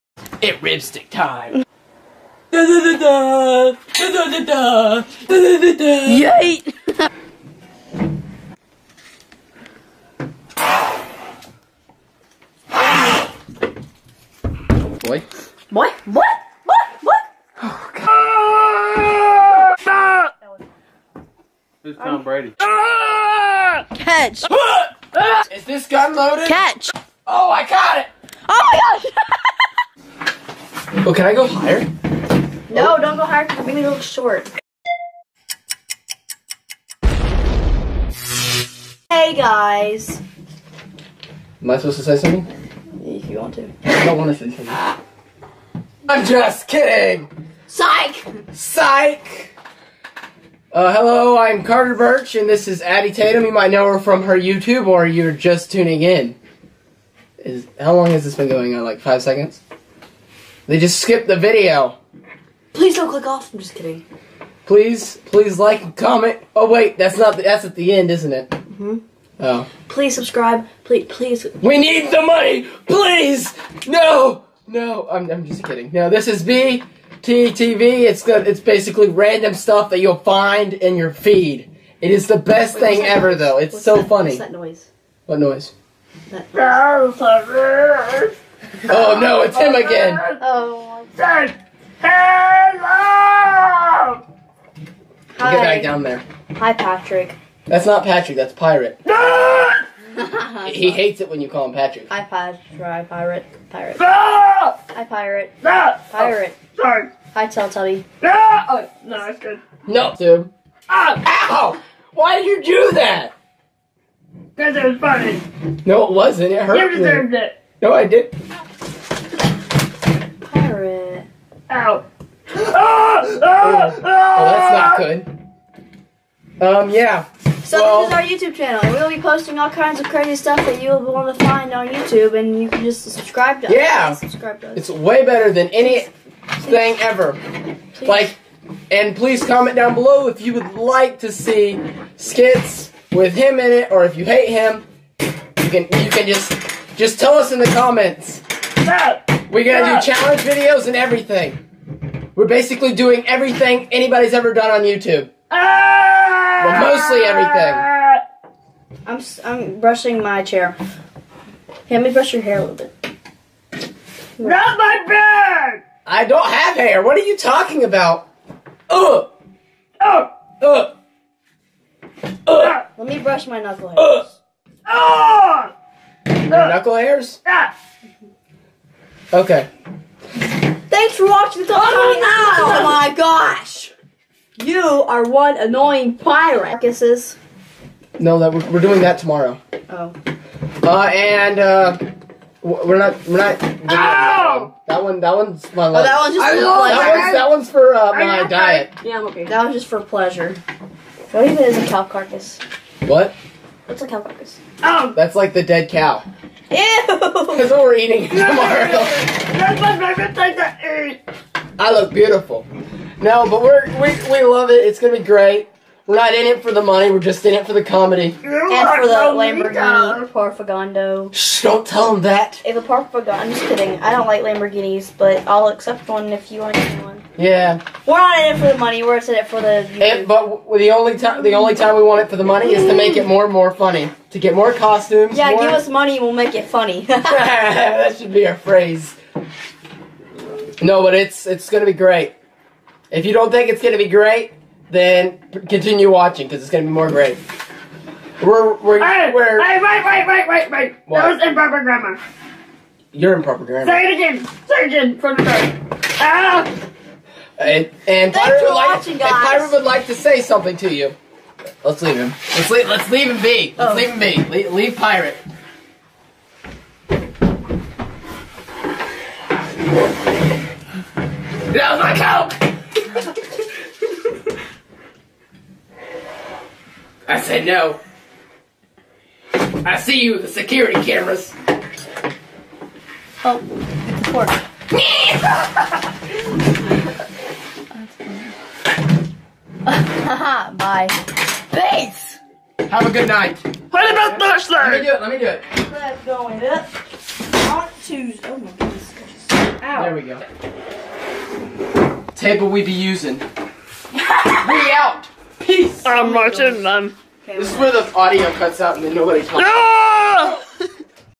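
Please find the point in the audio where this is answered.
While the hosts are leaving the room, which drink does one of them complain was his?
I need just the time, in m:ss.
4:32.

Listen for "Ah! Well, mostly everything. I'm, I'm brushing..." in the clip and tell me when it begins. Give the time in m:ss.
2:35.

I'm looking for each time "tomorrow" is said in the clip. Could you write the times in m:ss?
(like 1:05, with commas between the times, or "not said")
3:09, 3:28.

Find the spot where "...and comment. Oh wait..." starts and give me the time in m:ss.
1:05.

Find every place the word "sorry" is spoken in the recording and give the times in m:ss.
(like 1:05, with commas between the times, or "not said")
1:46.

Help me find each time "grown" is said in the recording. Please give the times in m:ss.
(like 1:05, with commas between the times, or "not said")
not said.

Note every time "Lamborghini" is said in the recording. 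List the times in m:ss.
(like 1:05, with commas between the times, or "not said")
3:39, 3:44.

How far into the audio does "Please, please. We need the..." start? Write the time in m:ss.
1:10.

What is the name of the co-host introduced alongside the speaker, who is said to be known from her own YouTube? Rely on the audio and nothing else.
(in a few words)
Addie Tatum.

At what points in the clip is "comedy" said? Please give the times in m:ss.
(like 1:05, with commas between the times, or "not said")
3:37.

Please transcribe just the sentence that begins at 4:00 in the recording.
No, but it's it's gonna be great.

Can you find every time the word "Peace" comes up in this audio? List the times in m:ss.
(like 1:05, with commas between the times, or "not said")
5:05.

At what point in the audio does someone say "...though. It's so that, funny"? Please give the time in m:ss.
1:23.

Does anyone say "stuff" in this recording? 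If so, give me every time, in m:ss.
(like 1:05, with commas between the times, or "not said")
1:19, 2:10.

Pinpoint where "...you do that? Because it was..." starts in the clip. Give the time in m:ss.
1:52.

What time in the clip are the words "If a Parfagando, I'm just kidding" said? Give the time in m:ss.
3:42.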